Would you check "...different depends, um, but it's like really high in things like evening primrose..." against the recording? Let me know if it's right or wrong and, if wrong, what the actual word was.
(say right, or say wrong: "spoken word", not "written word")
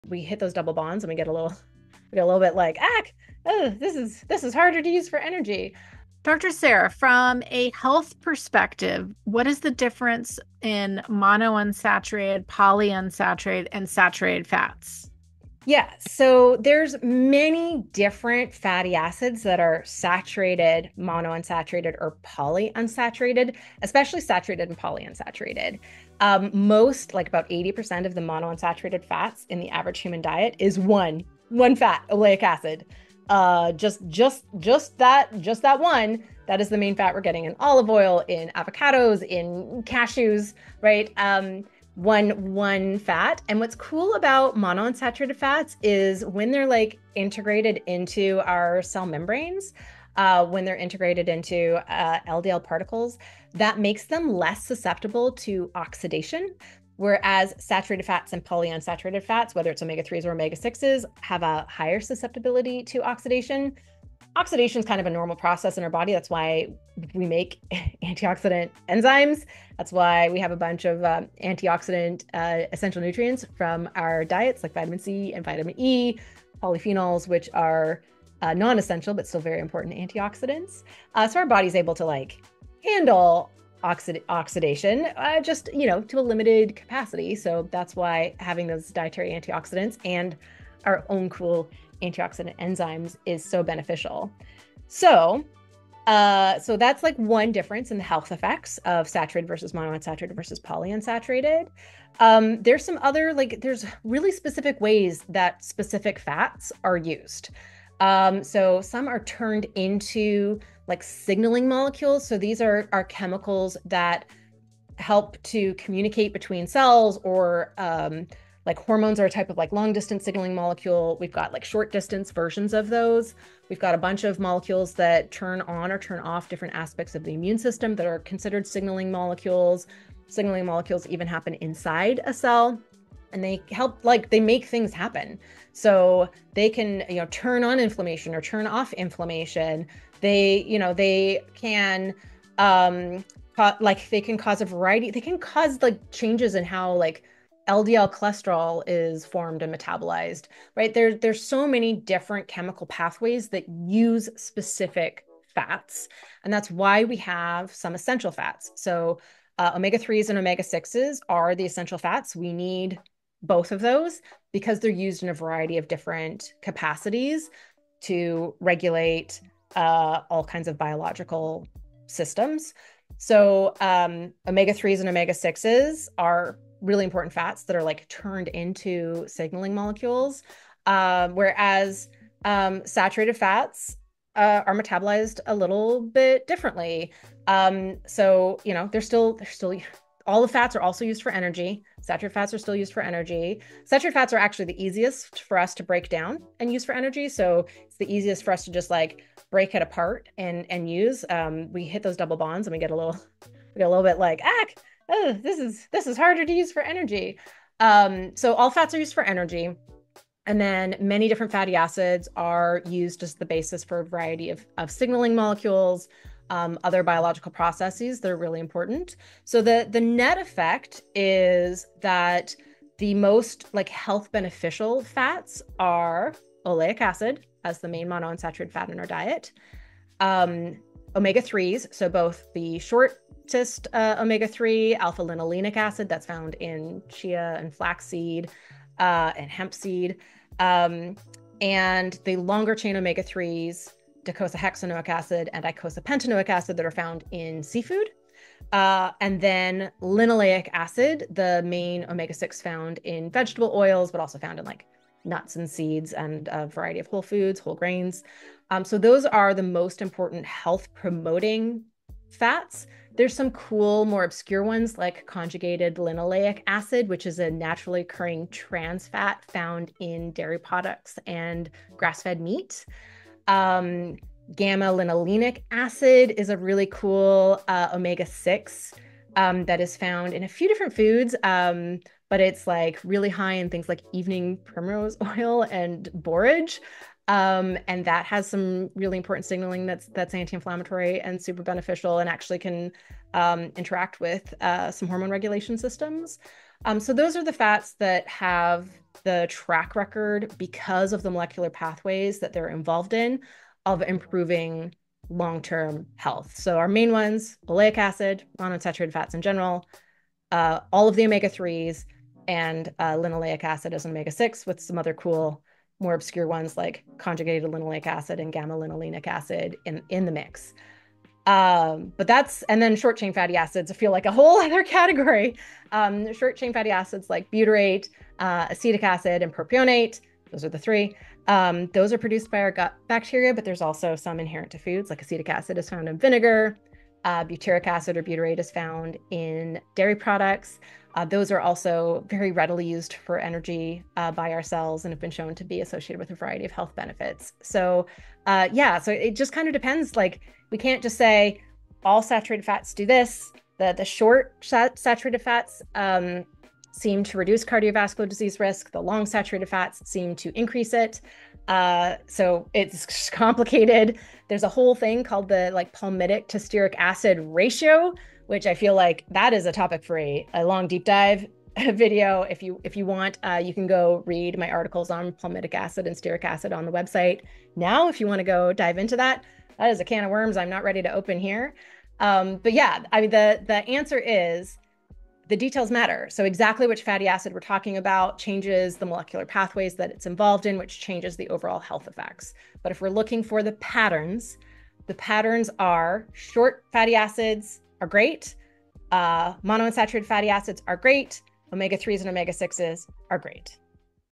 wrong: "foods", not "depends".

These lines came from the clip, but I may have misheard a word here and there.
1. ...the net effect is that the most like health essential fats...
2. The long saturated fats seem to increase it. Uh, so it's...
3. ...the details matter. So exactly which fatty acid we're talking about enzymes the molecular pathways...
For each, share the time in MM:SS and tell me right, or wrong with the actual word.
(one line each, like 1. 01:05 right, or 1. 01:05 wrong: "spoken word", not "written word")
1. 03:39 wrong: "beneficial", not "essential"
2. 05:58 right
3. 06:25 wrong: "changes", not "enzymes".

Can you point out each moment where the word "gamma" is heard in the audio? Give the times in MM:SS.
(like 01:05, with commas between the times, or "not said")
04:34, 05:18.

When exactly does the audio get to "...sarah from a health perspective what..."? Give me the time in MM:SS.
00:06.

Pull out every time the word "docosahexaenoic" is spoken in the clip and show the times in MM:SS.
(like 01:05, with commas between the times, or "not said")
04:04.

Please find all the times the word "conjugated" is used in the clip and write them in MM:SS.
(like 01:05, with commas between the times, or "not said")
04:25, 05:17.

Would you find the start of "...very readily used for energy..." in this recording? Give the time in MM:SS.
05:42.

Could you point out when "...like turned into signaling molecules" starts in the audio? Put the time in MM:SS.
02:57.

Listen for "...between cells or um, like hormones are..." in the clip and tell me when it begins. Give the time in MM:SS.
01:56.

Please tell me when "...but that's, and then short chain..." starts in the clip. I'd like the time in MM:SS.
05:22.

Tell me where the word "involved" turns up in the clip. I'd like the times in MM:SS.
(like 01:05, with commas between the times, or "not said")
05:02, 06:30.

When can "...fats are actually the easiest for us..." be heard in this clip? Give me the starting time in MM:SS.
03:14.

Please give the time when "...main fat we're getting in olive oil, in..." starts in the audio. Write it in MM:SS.
00:36.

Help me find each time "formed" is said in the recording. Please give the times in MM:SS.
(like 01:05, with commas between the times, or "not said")
02:29.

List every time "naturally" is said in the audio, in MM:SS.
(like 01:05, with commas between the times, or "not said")
04:27.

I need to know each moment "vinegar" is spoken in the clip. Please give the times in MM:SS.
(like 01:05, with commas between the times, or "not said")
05:36.